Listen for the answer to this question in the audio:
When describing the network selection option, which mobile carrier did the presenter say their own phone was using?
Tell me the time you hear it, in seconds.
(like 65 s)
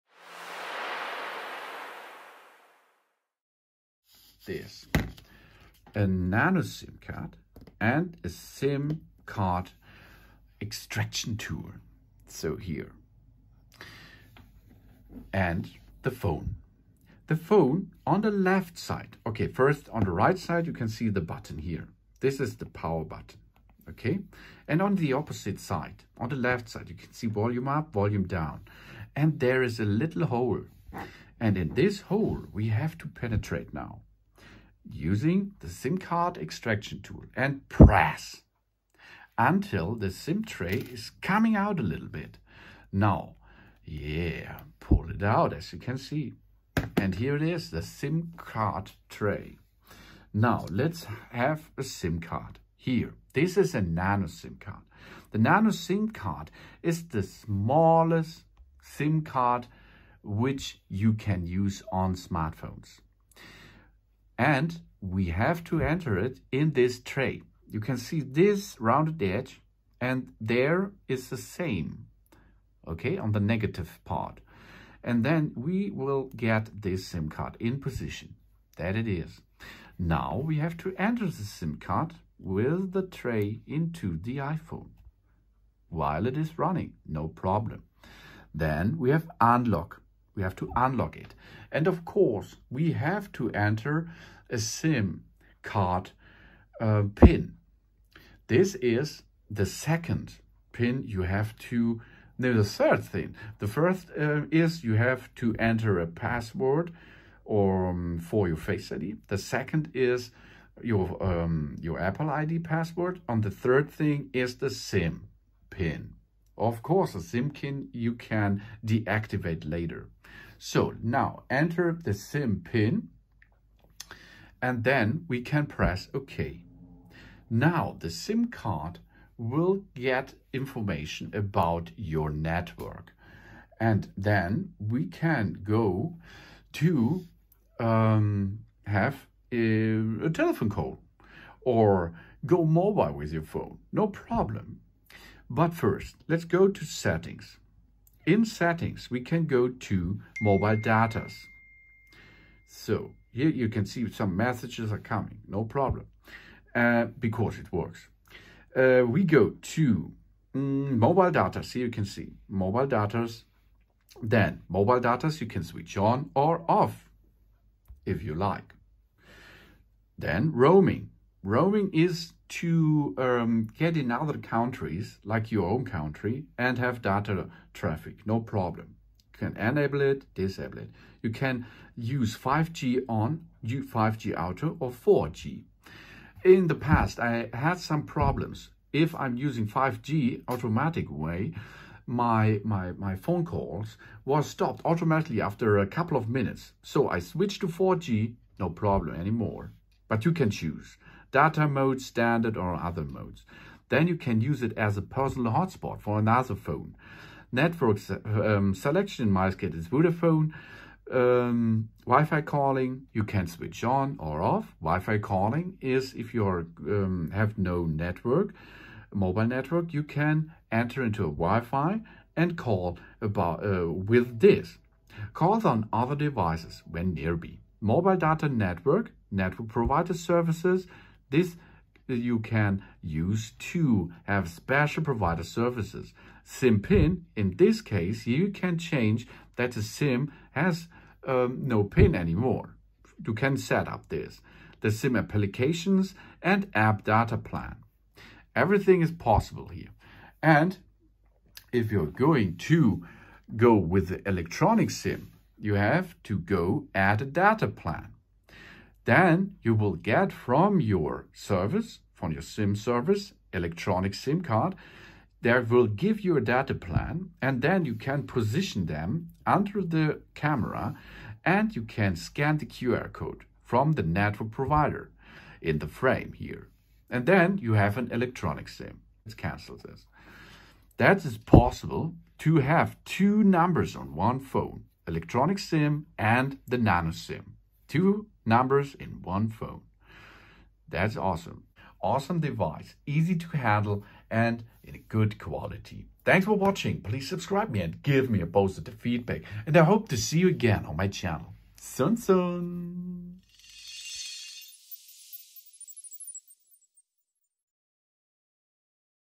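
209 s.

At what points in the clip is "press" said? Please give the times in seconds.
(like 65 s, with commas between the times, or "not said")
37 s, 125 s.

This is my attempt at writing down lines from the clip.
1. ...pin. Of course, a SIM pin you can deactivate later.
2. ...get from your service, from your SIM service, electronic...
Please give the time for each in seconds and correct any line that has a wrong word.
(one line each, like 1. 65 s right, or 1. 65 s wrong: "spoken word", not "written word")
1. 115 s right
2. 259 s right.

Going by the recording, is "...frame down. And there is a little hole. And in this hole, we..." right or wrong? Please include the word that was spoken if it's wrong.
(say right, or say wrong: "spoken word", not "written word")
wrong: "volume", not "frame".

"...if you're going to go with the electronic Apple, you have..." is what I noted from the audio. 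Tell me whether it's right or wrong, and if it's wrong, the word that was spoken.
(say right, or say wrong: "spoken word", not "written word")
wrong: "SIM", not "Apple".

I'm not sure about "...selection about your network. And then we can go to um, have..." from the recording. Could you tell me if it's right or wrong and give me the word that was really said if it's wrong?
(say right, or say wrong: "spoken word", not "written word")
wrong: "information", not "selection".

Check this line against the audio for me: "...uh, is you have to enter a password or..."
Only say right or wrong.
right.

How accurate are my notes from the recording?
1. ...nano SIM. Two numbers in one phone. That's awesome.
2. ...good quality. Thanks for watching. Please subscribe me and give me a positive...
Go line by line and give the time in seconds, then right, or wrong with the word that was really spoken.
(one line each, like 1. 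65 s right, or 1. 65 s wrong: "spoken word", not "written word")
1. 286 s right
2. 295 s right.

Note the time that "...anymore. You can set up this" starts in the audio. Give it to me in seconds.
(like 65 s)
242 s.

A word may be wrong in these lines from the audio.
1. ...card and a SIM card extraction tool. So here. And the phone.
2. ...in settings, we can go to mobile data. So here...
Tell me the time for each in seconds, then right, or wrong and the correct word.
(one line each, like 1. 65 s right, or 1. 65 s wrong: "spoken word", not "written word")
1. 7 s right
2. 148 s right.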